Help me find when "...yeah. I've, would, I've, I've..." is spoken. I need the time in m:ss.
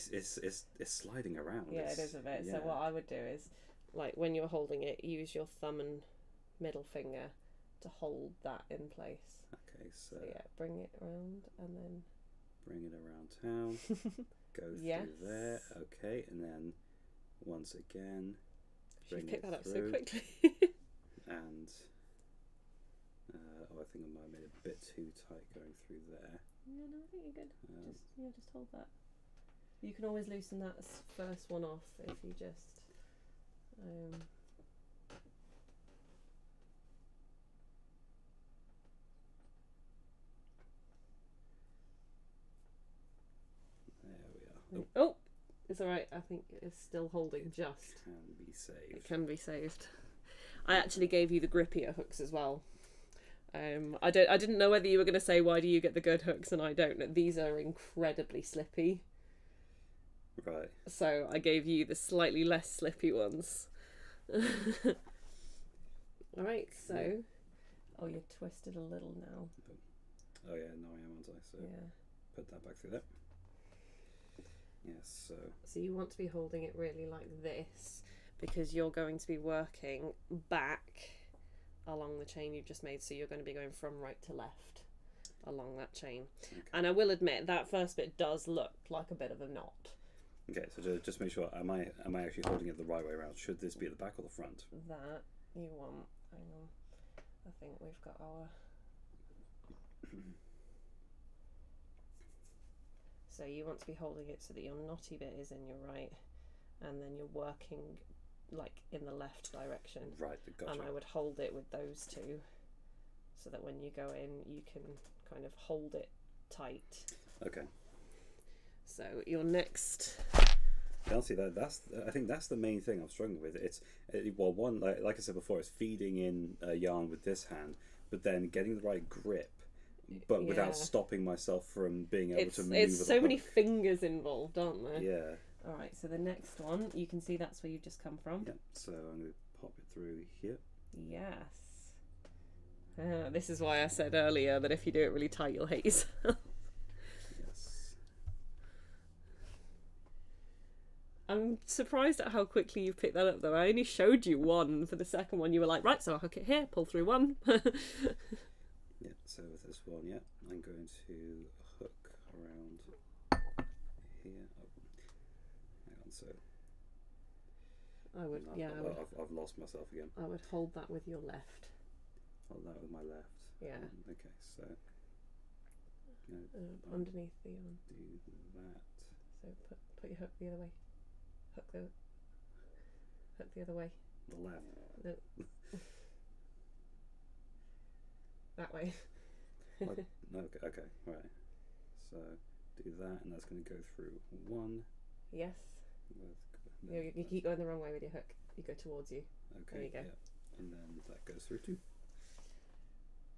2:48.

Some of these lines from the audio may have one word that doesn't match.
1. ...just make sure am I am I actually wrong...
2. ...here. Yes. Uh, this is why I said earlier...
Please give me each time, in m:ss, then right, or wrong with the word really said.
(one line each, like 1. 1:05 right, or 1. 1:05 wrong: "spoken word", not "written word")
1. 1:30 wrong: "holding", not "wrong"
2. 2:20 right.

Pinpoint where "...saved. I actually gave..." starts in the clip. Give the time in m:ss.
0:49.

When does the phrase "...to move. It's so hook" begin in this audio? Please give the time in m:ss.
2:12.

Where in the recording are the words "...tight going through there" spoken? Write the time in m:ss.
0:25.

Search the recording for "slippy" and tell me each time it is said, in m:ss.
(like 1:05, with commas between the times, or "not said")
0:58, 1:02.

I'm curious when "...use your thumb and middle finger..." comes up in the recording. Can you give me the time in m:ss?
0:05.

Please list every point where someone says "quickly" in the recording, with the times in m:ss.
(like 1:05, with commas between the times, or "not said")
0:19, 2:32.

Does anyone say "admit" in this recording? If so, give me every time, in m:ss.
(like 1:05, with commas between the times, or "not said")
1:27.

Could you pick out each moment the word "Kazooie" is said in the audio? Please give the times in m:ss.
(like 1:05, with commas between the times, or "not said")
not said.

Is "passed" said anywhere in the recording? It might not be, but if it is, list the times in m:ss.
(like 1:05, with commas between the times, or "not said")
not said.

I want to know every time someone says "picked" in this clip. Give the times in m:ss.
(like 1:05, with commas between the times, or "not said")
0:19, 2:32.